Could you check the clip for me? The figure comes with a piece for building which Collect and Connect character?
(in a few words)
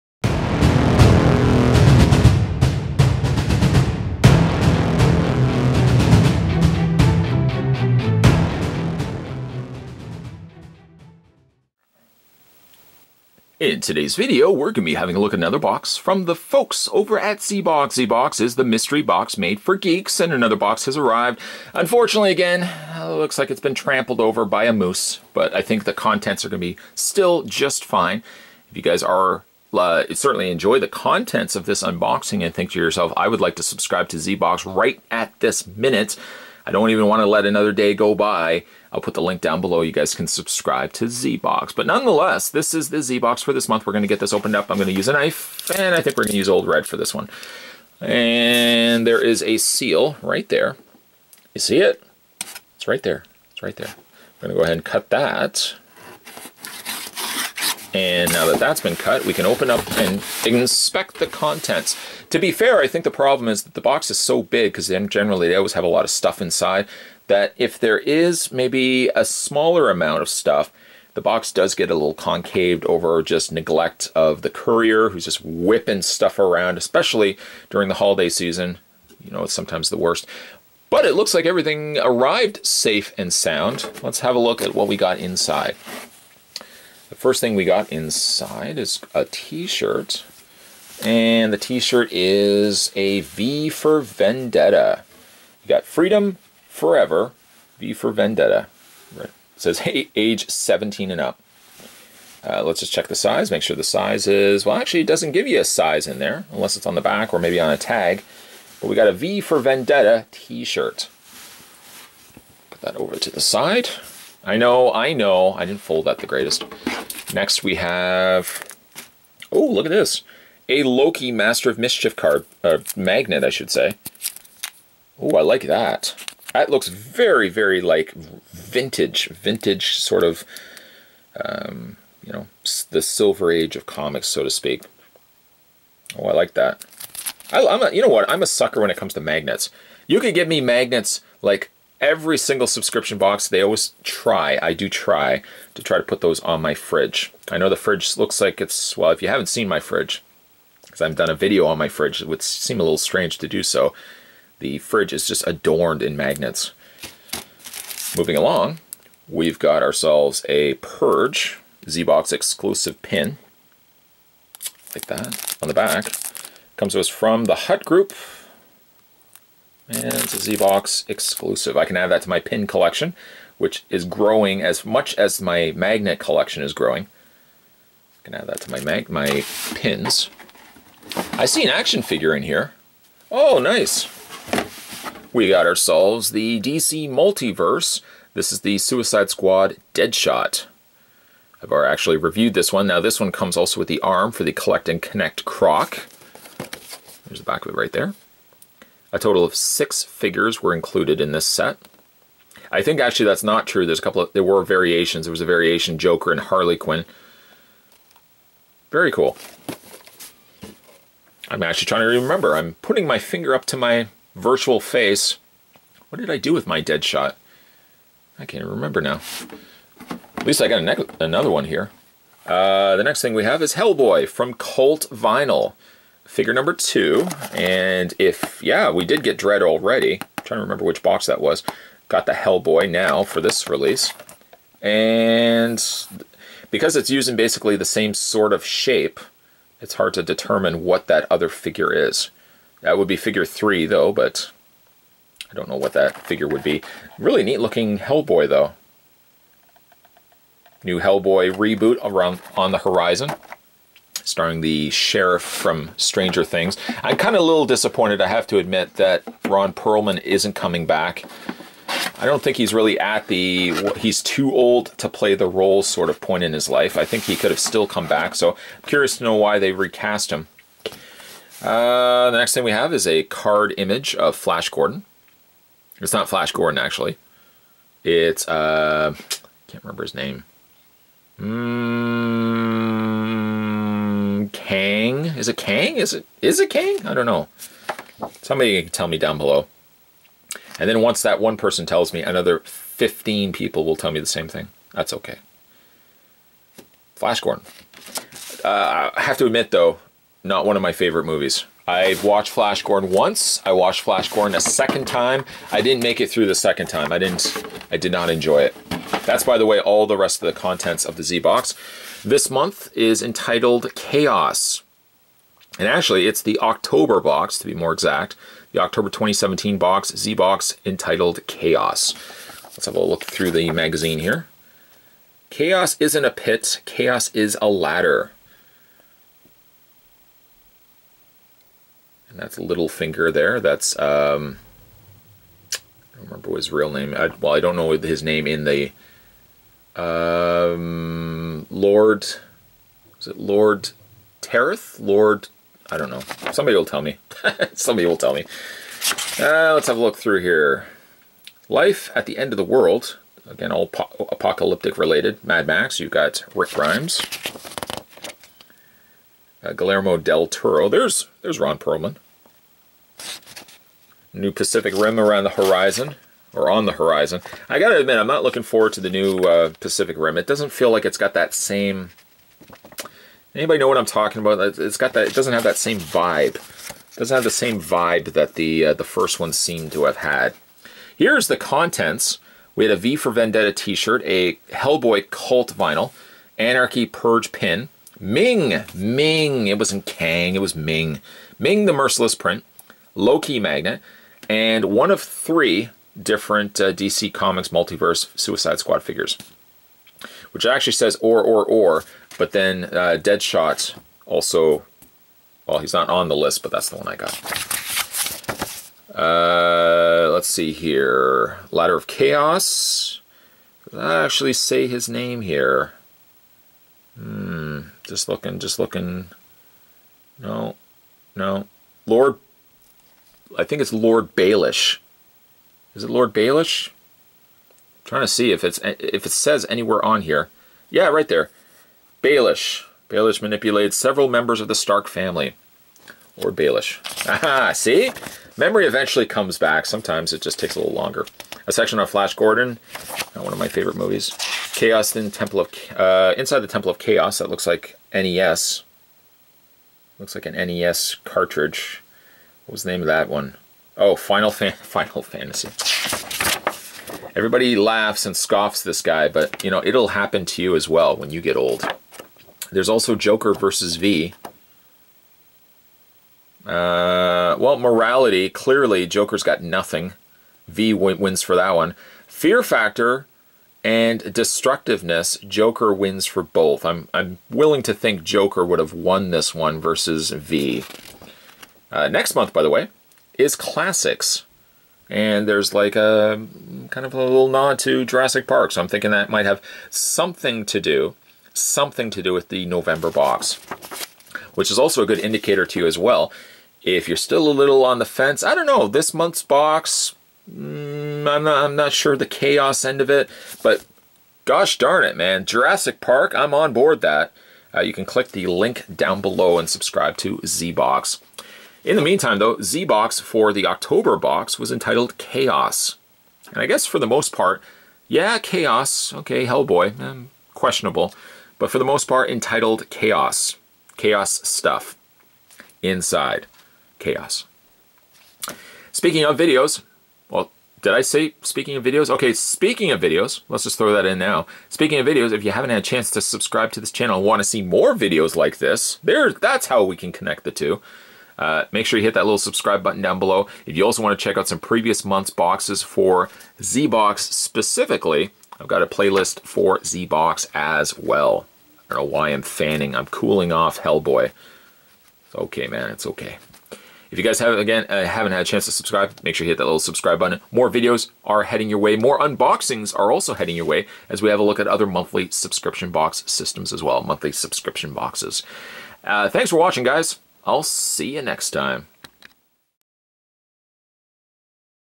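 Croc.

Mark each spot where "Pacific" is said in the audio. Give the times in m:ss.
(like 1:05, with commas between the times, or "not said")
6:04, 6:09.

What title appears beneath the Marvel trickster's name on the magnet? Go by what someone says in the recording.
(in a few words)
Master of Mischief.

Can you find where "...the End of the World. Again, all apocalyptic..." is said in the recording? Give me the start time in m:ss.
5:52.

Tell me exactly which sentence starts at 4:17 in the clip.
I'm kind of a little disappointed, I have to admit, that Ron Perlman isn't coming back.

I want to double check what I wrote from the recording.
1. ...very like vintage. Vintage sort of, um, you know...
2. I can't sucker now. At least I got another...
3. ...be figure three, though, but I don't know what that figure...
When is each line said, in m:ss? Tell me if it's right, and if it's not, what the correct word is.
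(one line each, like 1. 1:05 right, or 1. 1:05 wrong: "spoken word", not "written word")
1. 2:07 right
2. 3:38 wrong: "remember", not "sucker"
3. 4:03 right.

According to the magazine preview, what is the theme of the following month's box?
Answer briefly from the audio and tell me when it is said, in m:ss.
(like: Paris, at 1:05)
Classics, at 8:03.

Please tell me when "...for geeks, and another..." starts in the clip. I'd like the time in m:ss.
0:19.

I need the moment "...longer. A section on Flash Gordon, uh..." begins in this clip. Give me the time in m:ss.
7:20.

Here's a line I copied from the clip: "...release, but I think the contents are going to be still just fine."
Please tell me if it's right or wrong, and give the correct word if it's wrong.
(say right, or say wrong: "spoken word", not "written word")
wrong: "moose", not "release".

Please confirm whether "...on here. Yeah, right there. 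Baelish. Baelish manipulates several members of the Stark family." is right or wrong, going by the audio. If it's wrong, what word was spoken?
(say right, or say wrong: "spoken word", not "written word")
right.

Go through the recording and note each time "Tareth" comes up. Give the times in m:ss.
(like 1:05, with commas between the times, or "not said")
5:44.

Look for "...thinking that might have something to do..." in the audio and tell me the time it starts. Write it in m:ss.
8:08.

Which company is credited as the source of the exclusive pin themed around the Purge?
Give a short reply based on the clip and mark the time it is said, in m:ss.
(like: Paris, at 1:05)
the Hut Group, at 2:47.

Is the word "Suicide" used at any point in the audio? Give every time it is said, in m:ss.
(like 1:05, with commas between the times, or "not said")
3:08, 6:38.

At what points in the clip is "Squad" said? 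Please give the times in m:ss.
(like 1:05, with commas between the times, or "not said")
3:09, 6:38.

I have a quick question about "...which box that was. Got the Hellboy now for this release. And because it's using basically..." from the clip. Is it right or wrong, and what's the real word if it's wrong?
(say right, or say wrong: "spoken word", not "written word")
right.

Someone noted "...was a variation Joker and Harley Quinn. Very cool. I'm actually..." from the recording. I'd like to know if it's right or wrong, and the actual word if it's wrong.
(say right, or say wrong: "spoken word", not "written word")
right.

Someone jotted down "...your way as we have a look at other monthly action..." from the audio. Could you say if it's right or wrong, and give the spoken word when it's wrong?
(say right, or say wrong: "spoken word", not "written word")
wrong: "subscription", not "action".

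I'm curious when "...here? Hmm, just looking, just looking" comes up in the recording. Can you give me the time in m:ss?
6:55.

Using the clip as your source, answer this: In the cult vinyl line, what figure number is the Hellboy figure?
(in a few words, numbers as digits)
2.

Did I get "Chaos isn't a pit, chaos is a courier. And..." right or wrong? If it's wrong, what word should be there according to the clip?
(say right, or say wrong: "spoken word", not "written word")
wrong: "ladder", not "courier".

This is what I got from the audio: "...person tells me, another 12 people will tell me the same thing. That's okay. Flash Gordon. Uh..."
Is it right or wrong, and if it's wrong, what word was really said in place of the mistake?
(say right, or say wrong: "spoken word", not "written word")
wrong: "15", not "12".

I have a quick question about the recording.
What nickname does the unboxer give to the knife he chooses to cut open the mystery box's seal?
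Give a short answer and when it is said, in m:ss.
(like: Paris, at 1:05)
Old Red, at 0:46.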